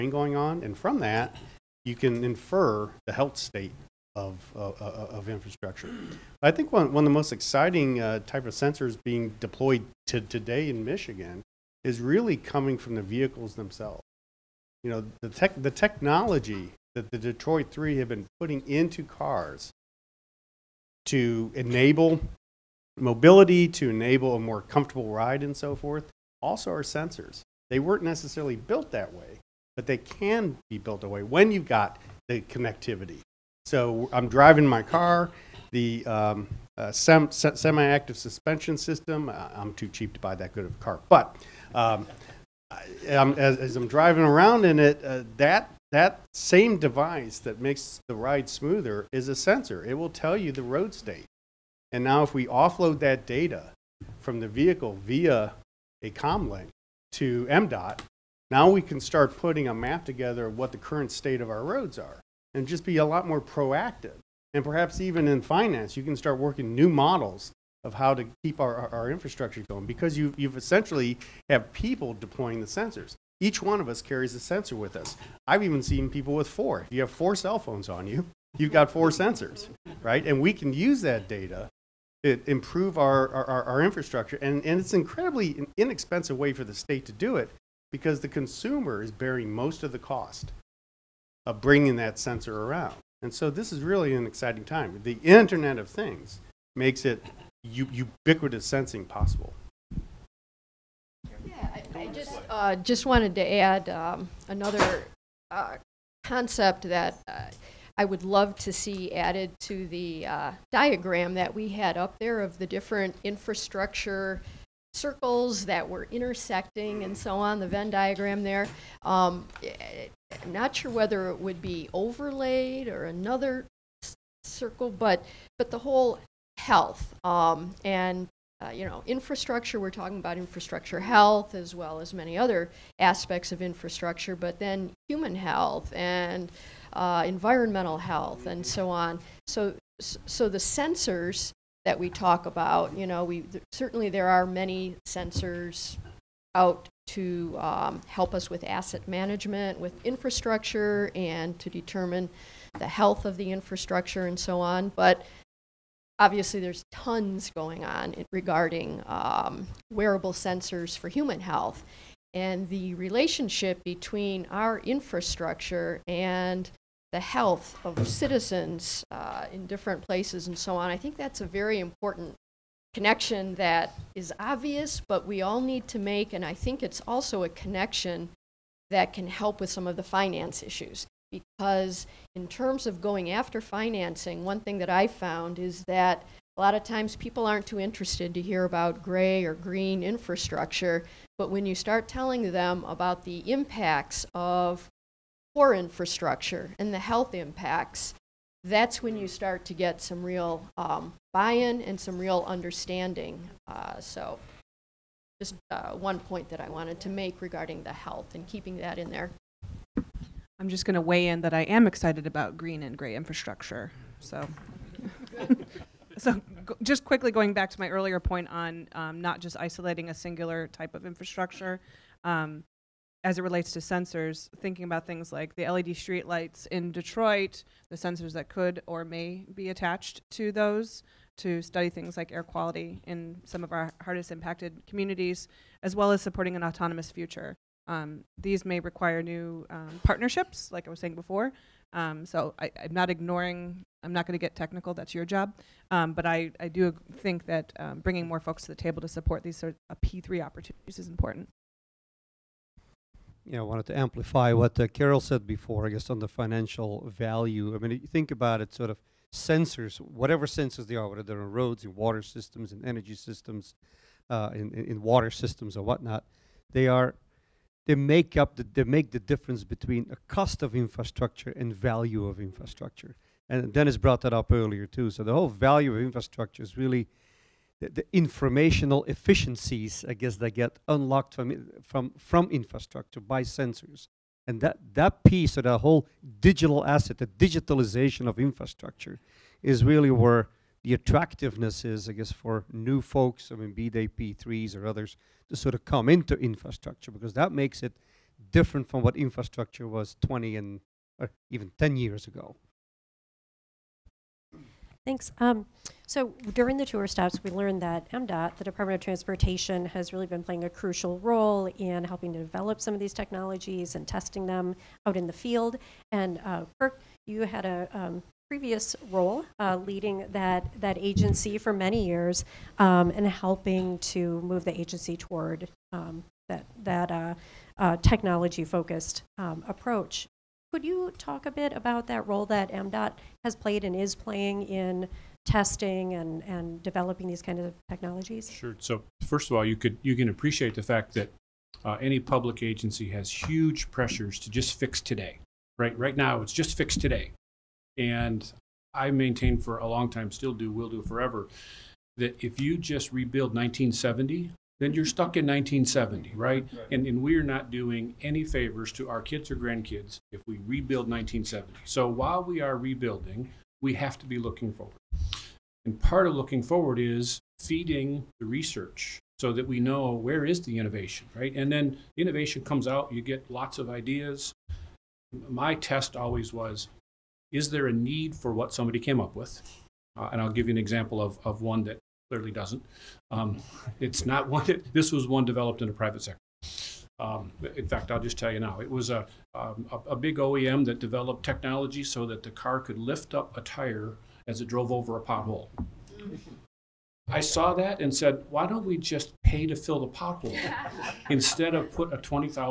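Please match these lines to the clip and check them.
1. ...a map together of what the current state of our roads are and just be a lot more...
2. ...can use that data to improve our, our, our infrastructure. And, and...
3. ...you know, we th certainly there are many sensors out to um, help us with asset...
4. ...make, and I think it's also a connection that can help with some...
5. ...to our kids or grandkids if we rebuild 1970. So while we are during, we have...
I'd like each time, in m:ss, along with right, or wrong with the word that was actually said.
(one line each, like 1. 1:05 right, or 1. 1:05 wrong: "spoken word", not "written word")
1. 0:59 right
2. 1:20 right
3. 2:22 right
4. 2:55 right
5. 5:58 wrong: "rebuilding", not "during".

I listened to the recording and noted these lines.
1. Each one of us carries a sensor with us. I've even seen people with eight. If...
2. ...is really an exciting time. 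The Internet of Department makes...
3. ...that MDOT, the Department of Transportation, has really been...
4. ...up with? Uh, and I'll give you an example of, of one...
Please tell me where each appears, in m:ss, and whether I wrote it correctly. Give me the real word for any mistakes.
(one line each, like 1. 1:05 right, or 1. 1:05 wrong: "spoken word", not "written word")
1. 1:13 wrong: "four", not "eight"
2. 1:33 wrong: "Things", not "Department"
3. 5:07 right
4. 6:19 right.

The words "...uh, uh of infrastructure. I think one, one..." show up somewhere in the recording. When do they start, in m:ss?
0:04.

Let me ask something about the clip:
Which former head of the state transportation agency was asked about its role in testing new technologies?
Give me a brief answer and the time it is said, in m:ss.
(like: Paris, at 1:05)
Kirk, at 5:16.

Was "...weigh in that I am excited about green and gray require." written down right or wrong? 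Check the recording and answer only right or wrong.
wrong.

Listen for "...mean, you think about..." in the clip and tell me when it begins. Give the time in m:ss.
4:17.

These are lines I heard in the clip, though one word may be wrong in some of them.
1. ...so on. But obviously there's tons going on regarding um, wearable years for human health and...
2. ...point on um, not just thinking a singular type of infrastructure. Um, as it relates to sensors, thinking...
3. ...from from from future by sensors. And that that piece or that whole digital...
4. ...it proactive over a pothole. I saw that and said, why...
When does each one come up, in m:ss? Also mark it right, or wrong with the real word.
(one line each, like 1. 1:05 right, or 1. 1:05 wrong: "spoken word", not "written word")
1. 2:34 wrong: "sensors", not "years"
2. 3:38 wrong: "isolating", not "thinking"
3. 4:41 wrong: "infrastructure", not "future"
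4. 6:34 wrong: "drove", not "proactive".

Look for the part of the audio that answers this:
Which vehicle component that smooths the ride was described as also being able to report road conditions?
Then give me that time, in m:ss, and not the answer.
0:37.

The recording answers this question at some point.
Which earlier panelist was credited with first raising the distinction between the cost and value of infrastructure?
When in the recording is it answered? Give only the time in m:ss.
4:33.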